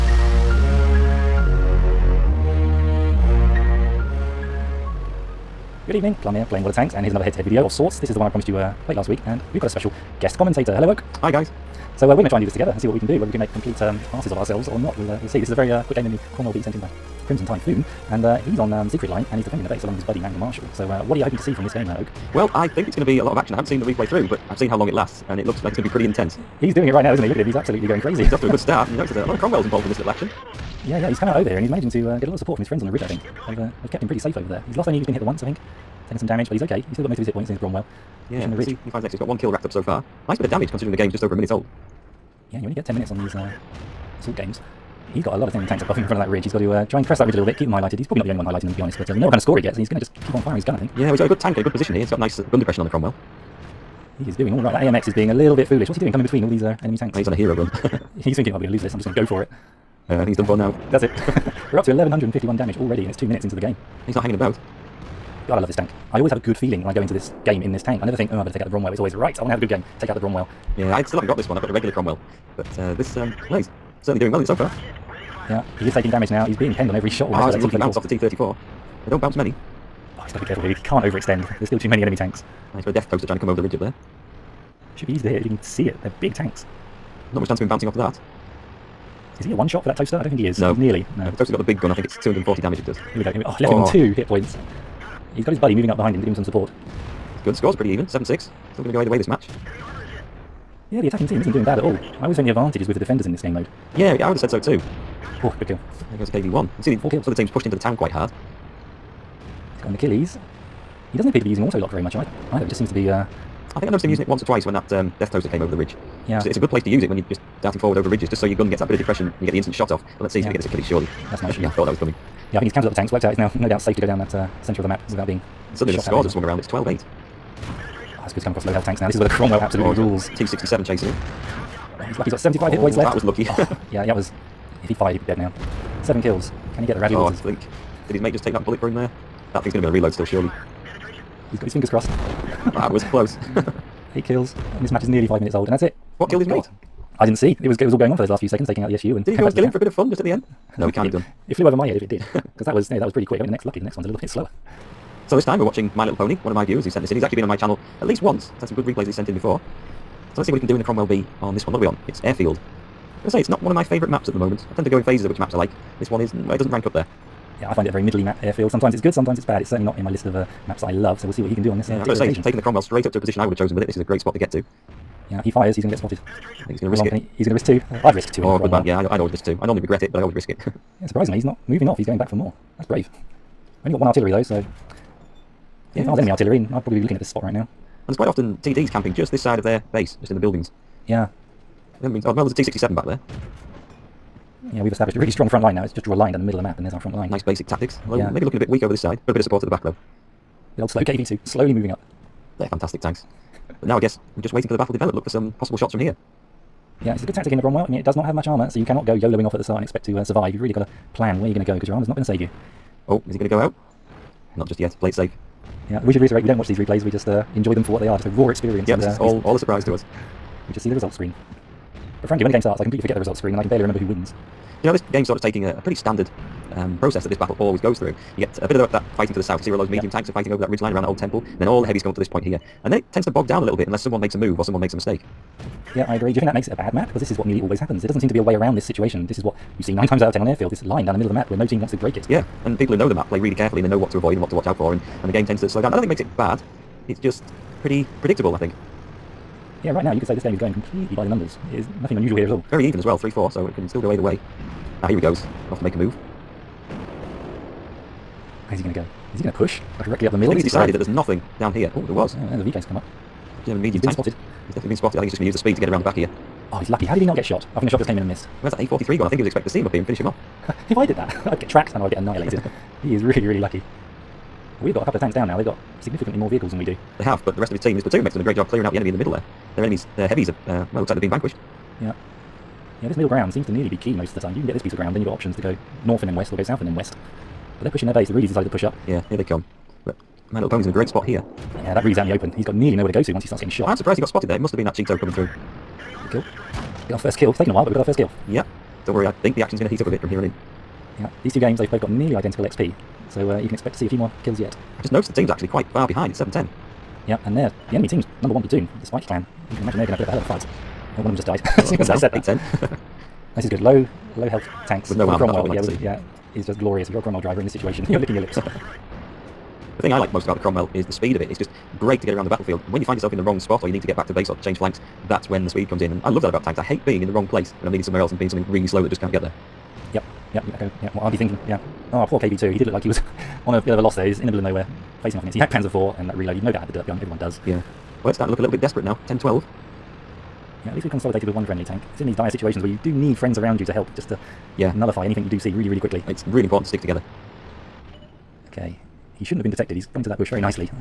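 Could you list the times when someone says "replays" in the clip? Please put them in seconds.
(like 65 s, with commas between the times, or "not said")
23 s, 158 s, 216 s.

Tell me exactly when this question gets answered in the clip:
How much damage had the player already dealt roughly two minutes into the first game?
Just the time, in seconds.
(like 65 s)
61 s.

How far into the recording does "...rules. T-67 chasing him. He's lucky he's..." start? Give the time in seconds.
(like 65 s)
129 s.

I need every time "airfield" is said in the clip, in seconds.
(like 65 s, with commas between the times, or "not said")
162 s, 168 s, 240 s.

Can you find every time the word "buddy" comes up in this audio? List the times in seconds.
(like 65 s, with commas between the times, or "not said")
20 s, 95 s.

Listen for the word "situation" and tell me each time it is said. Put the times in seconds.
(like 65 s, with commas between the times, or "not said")
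238 s, 317 s, 342 s.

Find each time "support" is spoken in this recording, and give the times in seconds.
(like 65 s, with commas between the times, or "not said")
32 s, 96 s, 199 s.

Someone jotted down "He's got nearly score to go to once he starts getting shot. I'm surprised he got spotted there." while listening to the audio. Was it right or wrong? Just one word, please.
wrong.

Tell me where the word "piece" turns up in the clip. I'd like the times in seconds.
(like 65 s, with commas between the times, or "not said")
284 s.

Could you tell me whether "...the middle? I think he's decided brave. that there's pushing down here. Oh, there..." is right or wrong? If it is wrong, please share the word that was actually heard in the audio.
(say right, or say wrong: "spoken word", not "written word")
wrong: "nothing", not "pushing".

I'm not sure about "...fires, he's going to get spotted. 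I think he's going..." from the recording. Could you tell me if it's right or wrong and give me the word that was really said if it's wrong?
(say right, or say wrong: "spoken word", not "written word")
right.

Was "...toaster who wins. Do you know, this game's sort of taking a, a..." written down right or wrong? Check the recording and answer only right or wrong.
wrong.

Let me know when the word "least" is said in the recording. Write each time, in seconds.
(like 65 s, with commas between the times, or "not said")
158 s, 340 s.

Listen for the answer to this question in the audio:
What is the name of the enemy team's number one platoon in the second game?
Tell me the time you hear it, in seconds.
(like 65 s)
309 s.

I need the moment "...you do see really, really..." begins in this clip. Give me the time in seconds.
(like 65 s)
345 s.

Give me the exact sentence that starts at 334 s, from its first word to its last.
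He's in the middle of nowhere facing off in it.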